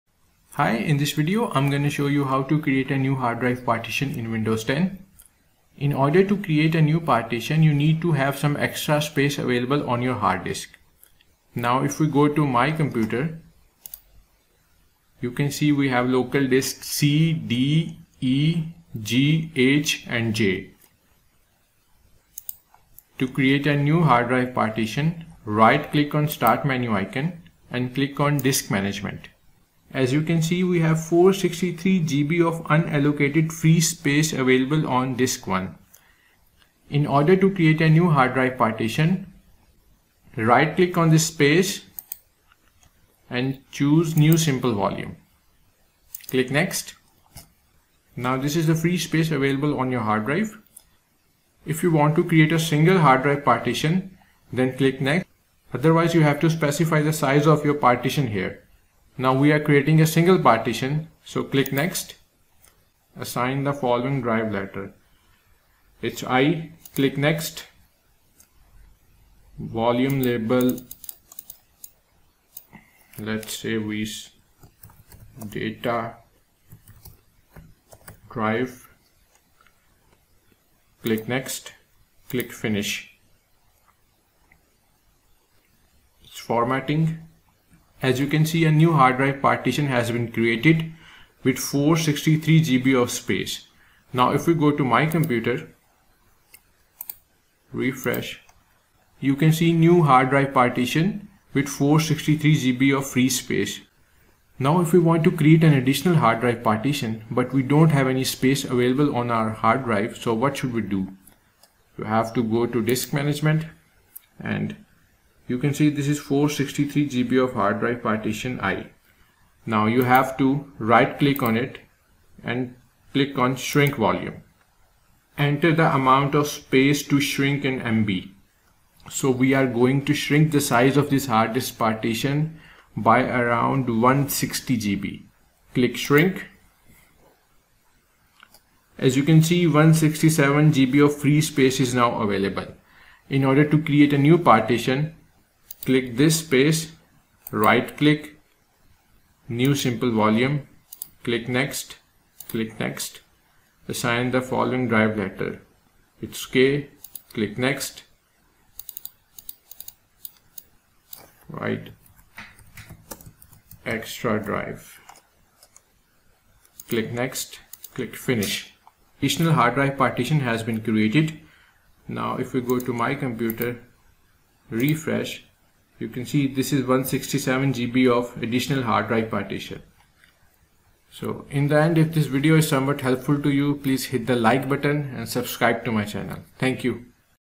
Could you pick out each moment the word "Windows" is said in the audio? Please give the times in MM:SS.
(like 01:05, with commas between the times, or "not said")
00:04.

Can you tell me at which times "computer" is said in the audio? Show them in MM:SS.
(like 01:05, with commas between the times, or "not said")
00:12, 01:35, 02:53.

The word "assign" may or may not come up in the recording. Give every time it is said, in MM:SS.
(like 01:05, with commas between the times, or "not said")
01:03, 02:33.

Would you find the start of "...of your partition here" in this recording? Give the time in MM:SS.
00:57.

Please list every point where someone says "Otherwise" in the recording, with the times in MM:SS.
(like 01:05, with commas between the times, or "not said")
00:55.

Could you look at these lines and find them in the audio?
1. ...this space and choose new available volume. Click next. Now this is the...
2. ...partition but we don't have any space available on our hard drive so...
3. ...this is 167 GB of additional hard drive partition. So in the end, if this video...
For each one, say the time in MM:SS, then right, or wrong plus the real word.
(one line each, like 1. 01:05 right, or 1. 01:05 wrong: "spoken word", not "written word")
1. 00:41 wrong: "simple", not "available"
2. 01:46 right
3. 02:56 right.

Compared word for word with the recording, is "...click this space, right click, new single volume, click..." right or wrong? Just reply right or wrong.
wrong.